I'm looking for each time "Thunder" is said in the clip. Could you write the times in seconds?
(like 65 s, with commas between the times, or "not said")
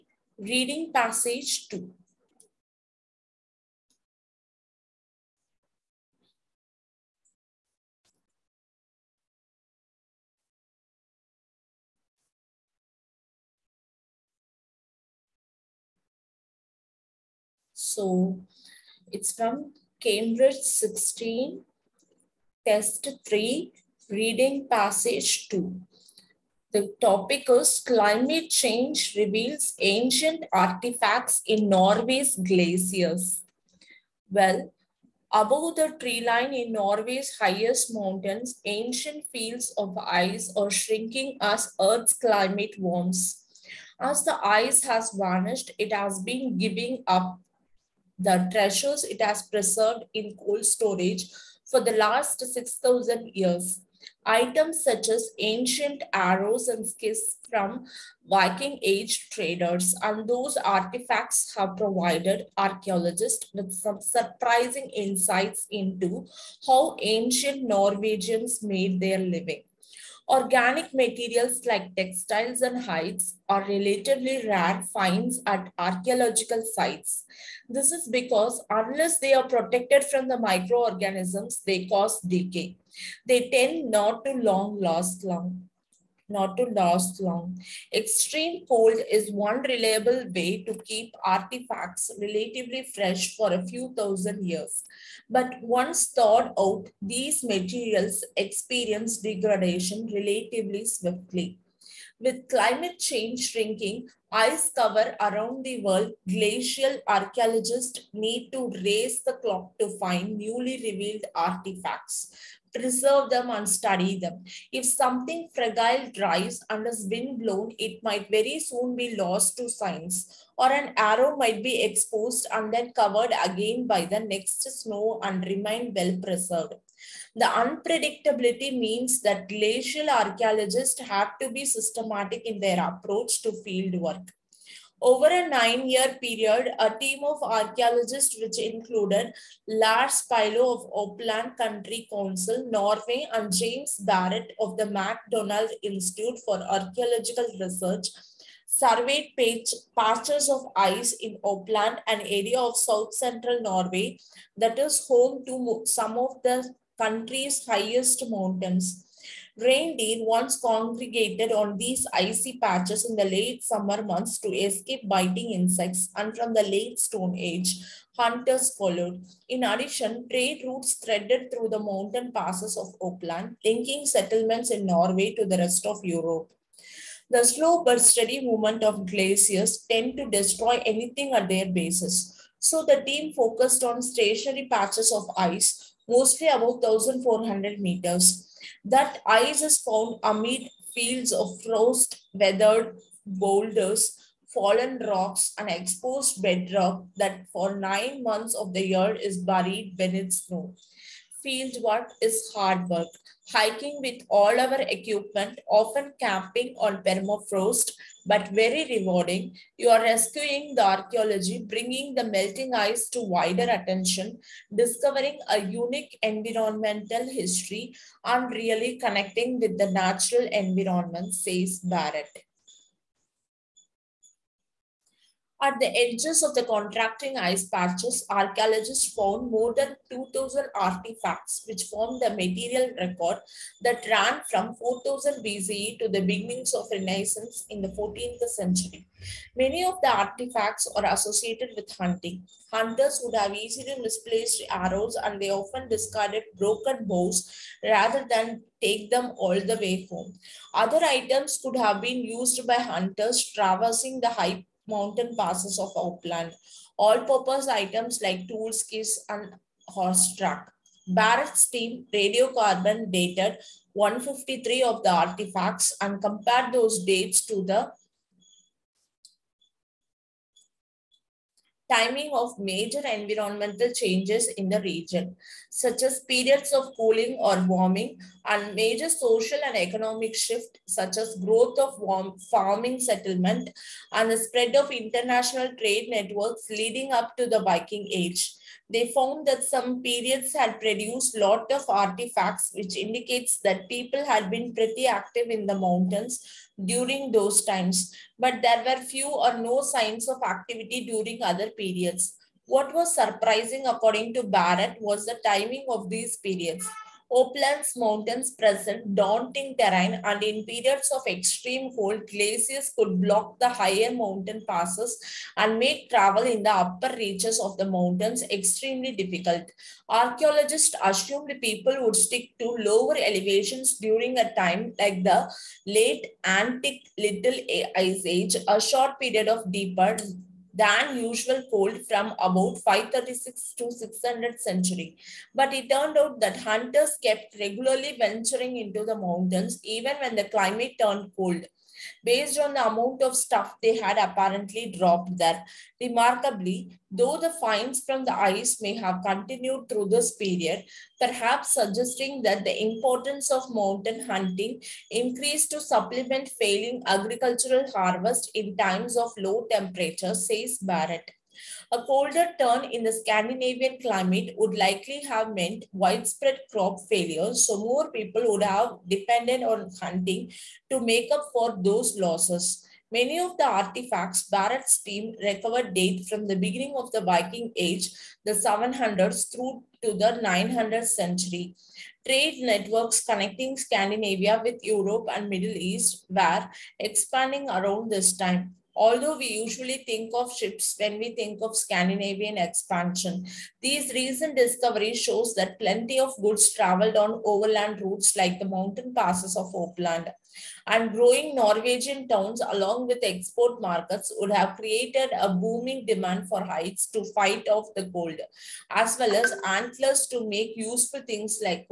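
not said.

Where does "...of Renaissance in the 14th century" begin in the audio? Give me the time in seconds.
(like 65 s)
236 s.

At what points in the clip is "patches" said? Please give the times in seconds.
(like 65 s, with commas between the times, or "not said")
149 s, 162 s, 184 s, 227 s.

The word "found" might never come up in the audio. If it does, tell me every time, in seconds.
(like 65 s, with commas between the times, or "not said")
189 s, 229 s, 289 s.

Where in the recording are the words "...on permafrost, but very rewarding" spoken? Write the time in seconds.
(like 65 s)
206 s.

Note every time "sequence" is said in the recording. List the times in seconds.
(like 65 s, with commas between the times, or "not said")
not said.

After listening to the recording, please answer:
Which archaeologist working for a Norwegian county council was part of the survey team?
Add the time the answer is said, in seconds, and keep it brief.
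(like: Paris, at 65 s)
Lars Pilo, at 139 s.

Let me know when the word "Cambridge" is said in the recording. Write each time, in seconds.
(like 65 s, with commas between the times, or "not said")
19 s.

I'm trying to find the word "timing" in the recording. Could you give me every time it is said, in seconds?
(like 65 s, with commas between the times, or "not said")
271 s, 305 s.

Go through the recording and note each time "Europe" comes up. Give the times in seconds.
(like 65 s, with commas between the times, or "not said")
176 s, 384 s.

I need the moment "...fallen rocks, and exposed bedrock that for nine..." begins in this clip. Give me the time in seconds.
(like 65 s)
194 s.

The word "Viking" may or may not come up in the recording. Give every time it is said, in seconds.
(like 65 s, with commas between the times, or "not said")
58 s, 287 s, 377 s.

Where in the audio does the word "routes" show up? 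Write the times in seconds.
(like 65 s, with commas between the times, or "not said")
170 s, 398 s.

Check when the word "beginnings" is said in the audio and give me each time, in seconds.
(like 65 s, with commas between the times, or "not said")
236 s, 376 s.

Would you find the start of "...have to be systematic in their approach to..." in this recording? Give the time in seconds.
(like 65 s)
131 s.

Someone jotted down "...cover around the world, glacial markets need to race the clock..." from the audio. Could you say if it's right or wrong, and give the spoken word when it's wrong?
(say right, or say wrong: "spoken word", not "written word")
wrong: "archaeologists", not "markets".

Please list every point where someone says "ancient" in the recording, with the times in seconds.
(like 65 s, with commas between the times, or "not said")
29 s, 38 s, 55 s, 67 s.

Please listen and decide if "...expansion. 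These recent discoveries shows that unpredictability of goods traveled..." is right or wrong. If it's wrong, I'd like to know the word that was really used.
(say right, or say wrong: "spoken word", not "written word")
wrong: "plenty", not "unpredictability".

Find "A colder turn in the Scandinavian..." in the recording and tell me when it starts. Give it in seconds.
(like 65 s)
361 s.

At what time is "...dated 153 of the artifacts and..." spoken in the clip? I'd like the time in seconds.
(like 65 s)
263 s.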